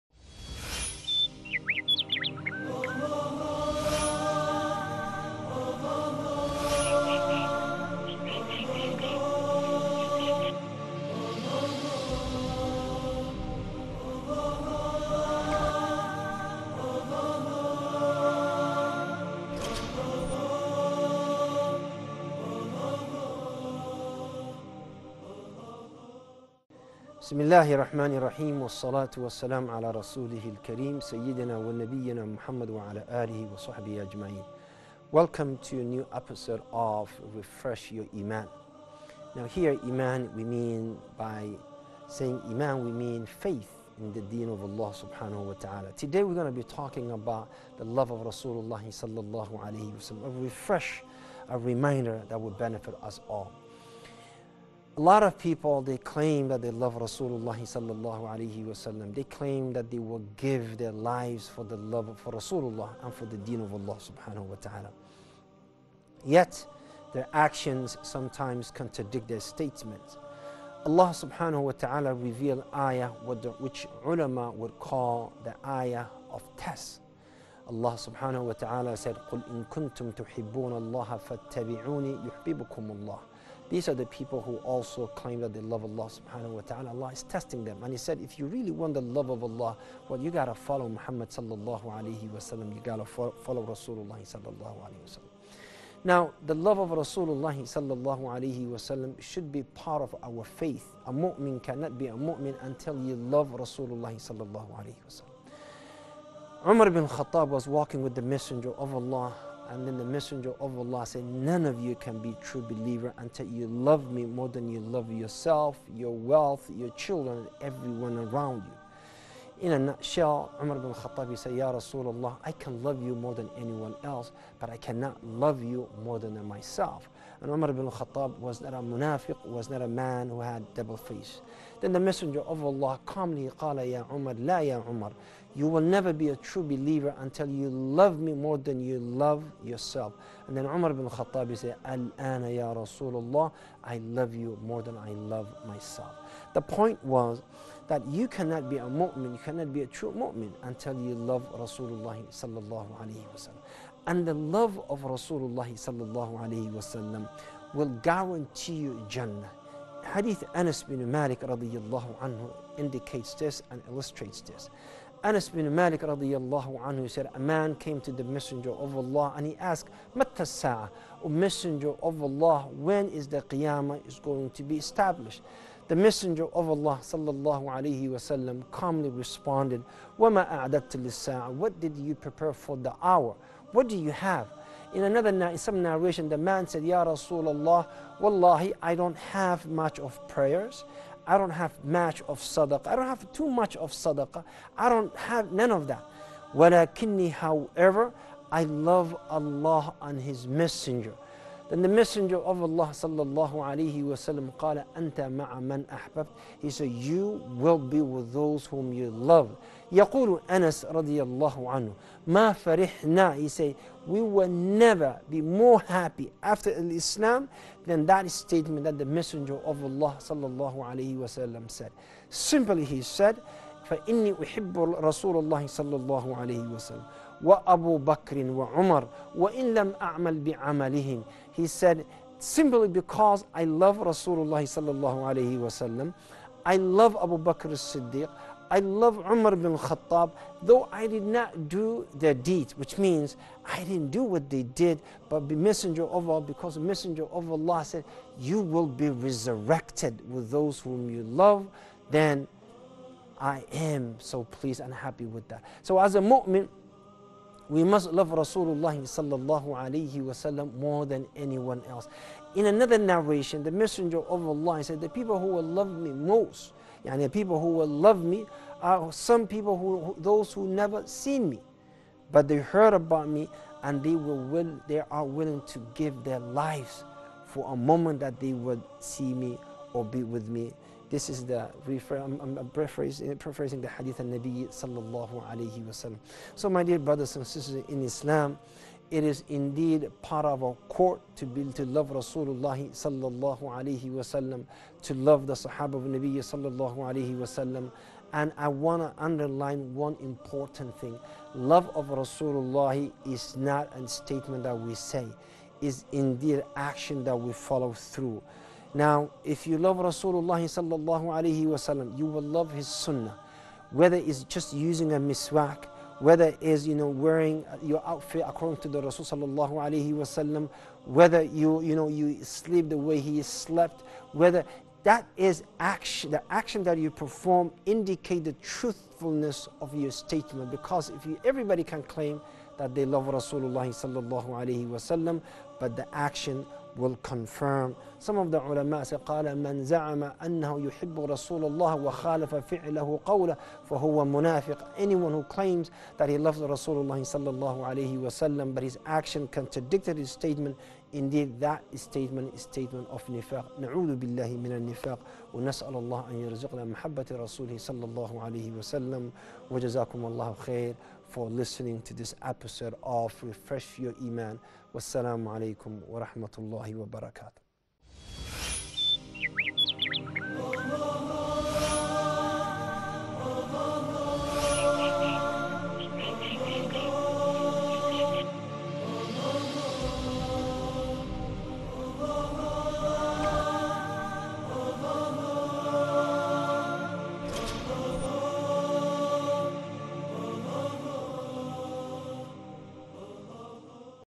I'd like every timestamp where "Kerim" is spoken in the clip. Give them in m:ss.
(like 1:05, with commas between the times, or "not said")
0:30.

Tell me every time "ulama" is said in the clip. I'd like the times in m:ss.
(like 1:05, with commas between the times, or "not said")
1:14, 5:38.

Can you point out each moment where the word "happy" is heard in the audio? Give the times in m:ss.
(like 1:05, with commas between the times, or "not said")
3:35, 4:14.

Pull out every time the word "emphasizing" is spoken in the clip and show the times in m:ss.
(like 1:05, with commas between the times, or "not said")
not said.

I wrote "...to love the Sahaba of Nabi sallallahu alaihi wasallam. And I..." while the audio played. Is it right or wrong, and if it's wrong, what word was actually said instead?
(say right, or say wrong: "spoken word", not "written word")
right.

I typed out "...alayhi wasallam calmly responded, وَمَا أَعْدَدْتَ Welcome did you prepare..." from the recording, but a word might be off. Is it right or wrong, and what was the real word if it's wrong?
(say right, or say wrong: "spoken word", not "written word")
wrong: "What", not "Welcome".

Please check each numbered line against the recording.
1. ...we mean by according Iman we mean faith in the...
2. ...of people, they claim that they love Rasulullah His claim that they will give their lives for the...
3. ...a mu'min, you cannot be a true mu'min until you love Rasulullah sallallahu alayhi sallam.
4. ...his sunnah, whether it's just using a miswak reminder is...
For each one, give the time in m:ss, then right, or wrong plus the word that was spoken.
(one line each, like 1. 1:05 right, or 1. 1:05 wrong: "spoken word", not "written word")
1. 0:40 wrong: "saying", not "according"
2. 0:55 wrong: "They", not "His"
3. 2:28 wrong: "wasallam", not "sallam"
4. 5:12 wrong: "whether", not "reminder".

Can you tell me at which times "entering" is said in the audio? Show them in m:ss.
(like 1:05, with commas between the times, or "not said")
not said.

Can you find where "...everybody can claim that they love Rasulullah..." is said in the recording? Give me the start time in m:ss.
5:31.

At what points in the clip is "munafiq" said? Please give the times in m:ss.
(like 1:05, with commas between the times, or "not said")
2:08, 5:44.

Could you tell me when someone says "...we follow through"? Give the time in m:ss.
5:07.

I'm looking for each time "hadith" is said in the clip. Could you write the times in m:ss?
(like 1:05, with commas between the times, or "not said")
2:40, 4:43.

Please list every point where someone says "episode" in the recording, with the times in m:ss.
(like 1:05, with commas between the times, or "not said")
0:36, 6:02.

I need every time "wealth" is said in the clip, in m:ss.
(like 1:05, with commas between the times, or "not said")
1:56.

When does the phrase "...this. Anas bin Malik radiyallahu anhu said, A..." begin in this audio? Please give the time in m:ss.
2:44.